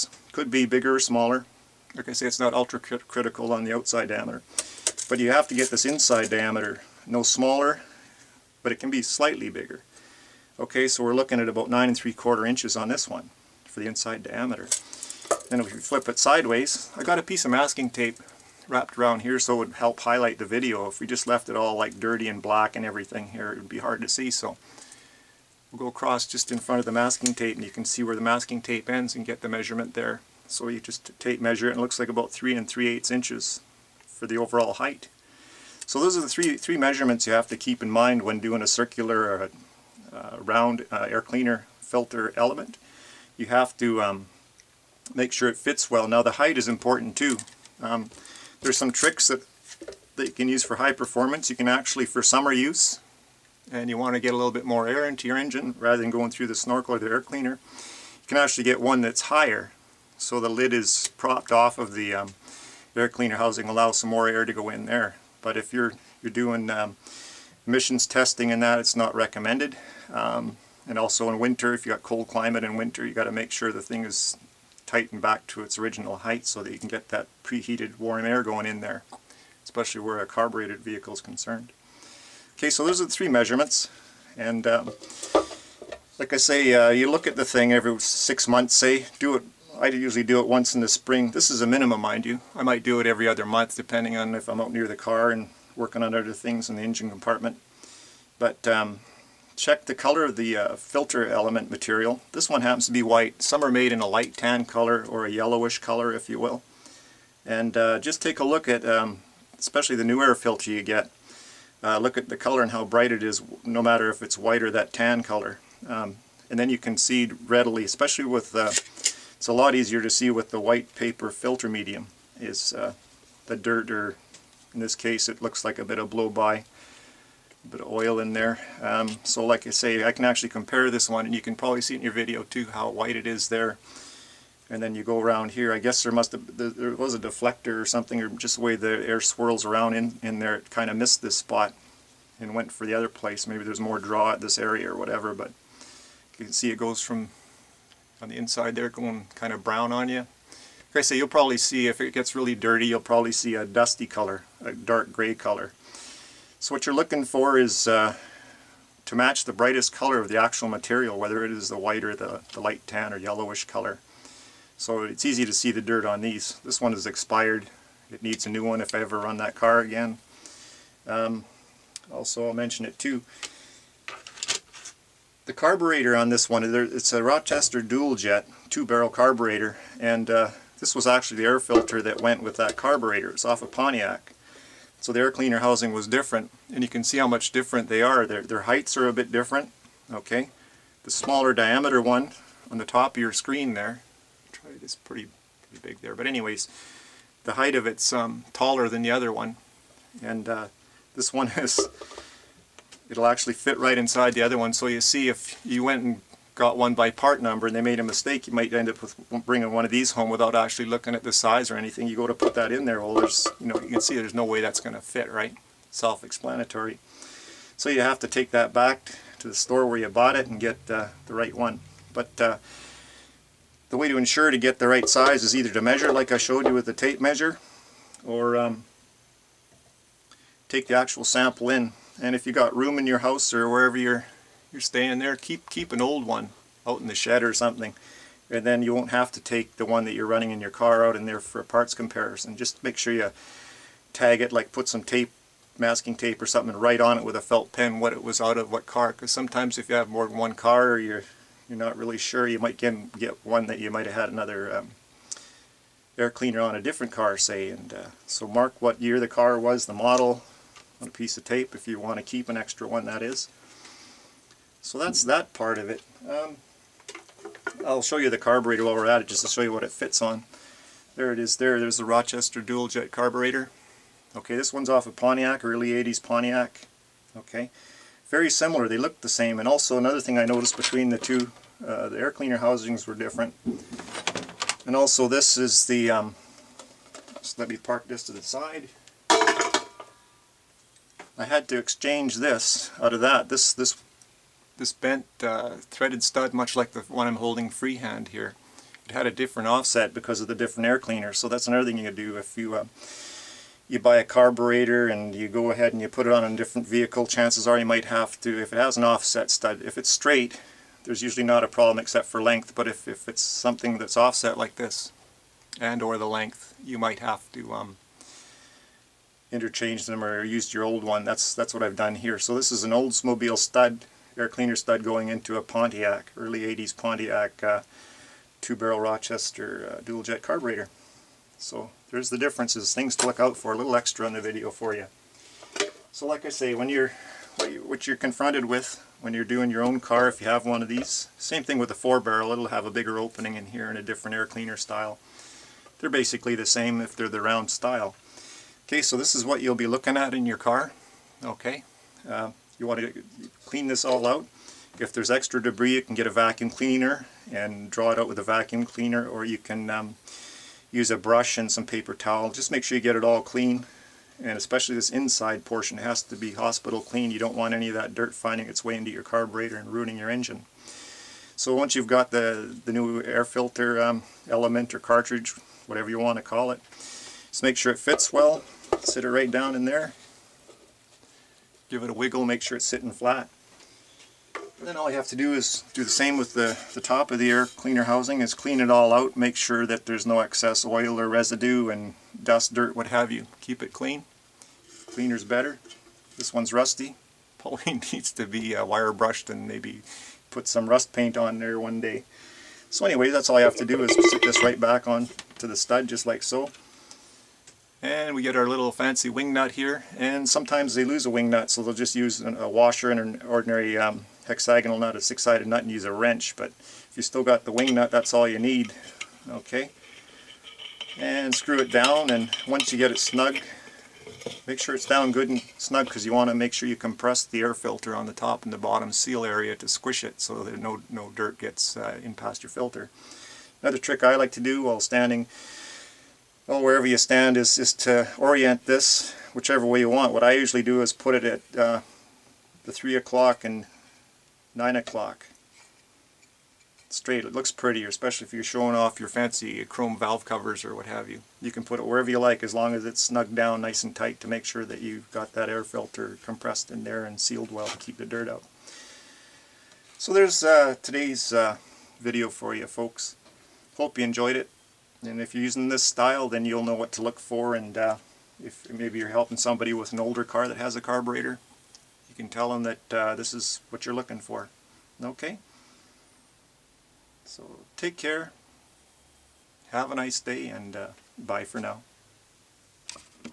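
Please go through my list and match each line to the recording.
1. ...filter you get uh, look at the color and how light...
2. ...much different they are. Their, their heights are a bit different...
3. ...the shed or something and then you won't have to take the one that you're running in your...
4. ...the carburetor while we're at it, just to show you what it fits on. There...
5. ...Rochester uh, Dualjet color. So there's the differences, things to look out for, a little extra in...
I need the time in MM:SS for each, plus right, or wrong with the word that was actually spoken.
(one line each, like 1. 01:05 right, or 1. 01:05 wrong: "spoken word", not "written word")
1. 01:50 wrong: "bright", not "light"
2. 03:07 right
3. 03:57 right
4. 04:28 right
5. 05:29 wrong: "carburetor", not "color".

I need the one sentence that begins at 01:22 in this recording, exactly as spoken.
Okay, so those are the three measurements.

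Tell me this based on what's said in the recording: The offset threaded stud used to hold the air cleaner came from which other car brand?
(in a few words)
Oldsmobile.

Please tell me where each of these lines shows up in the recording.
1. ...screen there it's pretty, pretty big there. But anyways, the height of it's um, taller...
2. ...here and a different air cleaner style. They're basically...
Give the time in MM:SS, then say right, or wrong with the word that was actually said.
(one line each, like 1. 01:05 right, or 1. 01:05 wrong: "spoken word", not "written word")
1. 03:13 right
2. 05:43 right.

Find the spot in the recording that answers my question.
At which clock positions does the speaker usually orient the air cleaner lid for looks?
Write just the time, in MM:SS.
07:22.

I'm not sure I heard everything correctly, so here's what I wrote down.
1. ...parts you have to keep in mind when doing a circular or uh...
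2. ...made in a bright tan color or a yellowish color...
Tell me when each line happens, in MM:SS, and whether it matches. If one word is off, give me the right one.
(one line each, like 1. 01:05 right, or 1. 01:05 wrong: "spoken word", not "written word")
1. 00:36 wrong: "measurements", not "parts"
2. 01:43 wrong: "light", not "bright".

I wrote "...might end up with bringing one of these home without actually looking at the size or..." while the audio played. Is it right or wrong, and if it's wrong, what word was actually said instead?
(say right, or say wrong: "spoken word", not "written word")
right.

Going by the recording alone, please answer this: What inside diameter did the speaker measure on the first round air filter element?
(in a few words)
9 3/4 inches.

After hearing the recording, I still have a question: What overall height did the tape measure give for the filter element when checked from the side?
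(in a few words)
3 3/8 inches.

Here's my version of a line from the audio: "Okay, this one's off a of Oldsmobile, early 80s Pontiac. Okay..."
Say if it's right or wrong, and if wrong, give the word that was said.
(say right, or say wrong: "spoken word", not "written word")
wrong: "Pontiac", not "Oldsmobile".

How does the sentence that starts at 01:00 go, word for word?
So the lid is propped off of the um, air cleaner housing, allows some more air to go in there.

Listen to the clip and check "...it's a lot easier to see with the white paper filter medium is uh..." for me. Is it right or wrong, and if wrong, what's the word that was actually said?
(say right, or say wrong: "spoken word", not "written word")
right.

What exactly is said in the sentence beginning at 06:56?
But if you still got the wing nut, that's all you need.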